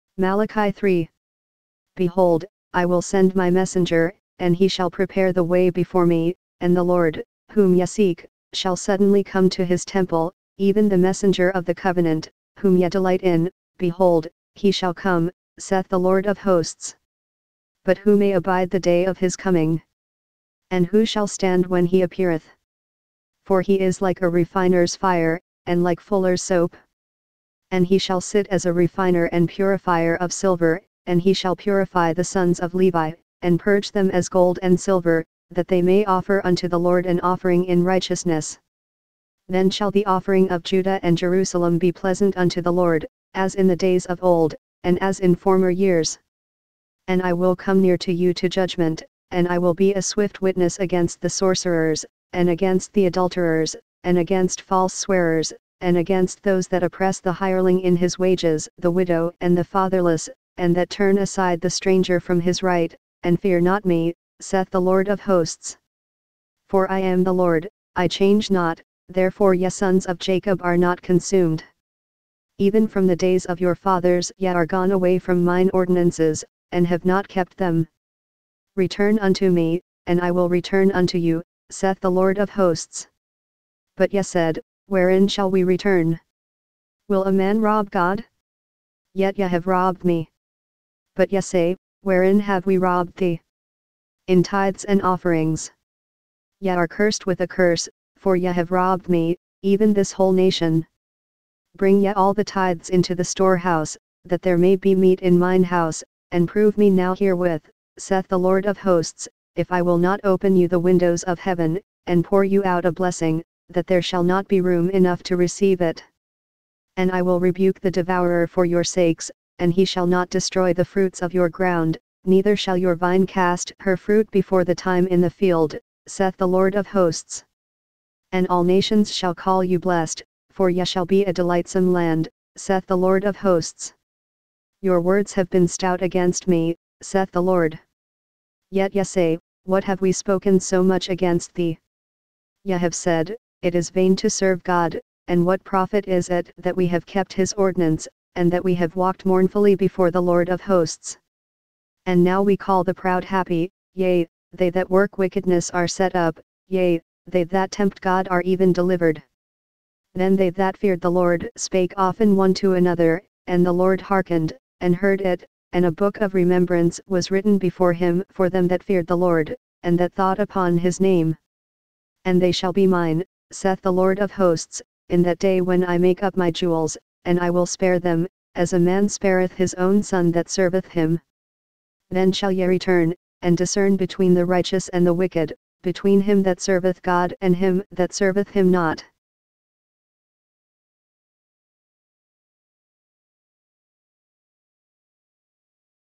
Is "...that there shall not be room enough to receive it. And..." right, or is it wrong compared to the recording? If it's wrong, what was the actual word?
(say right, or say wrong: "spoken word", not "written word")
right.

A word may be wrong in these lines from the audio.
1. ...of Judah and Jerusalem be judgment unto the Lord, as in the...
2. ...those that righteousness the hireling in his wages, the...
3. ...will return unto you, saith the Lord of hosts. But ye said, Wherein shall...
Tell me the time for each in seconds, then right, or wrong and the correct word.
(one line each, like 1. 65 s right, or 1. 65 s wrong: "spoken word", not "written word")
1. 40 s wrong: "pleasant", not "judgment"
2. 56 s wrong: "oppress", not "righteousness"
3. 80 s right.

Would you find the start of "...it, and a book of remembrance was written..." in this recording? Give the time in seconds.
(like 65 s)
165 s.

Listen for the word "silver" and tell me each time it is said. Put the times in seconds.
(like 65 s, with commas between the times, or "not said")
30 s, 34 s.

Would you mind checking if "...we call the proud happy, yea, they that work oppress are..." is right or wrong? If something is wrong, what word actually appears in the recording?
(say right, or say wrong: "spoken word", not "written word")
wrong: "wickedness", not "oppress".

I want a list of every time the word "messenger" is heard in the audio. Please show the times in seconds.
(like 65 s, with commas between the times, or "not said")
3 s, 10 s.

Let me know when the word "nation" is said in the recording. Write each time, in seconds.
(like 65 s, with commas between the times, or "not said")
100 s, 128 s.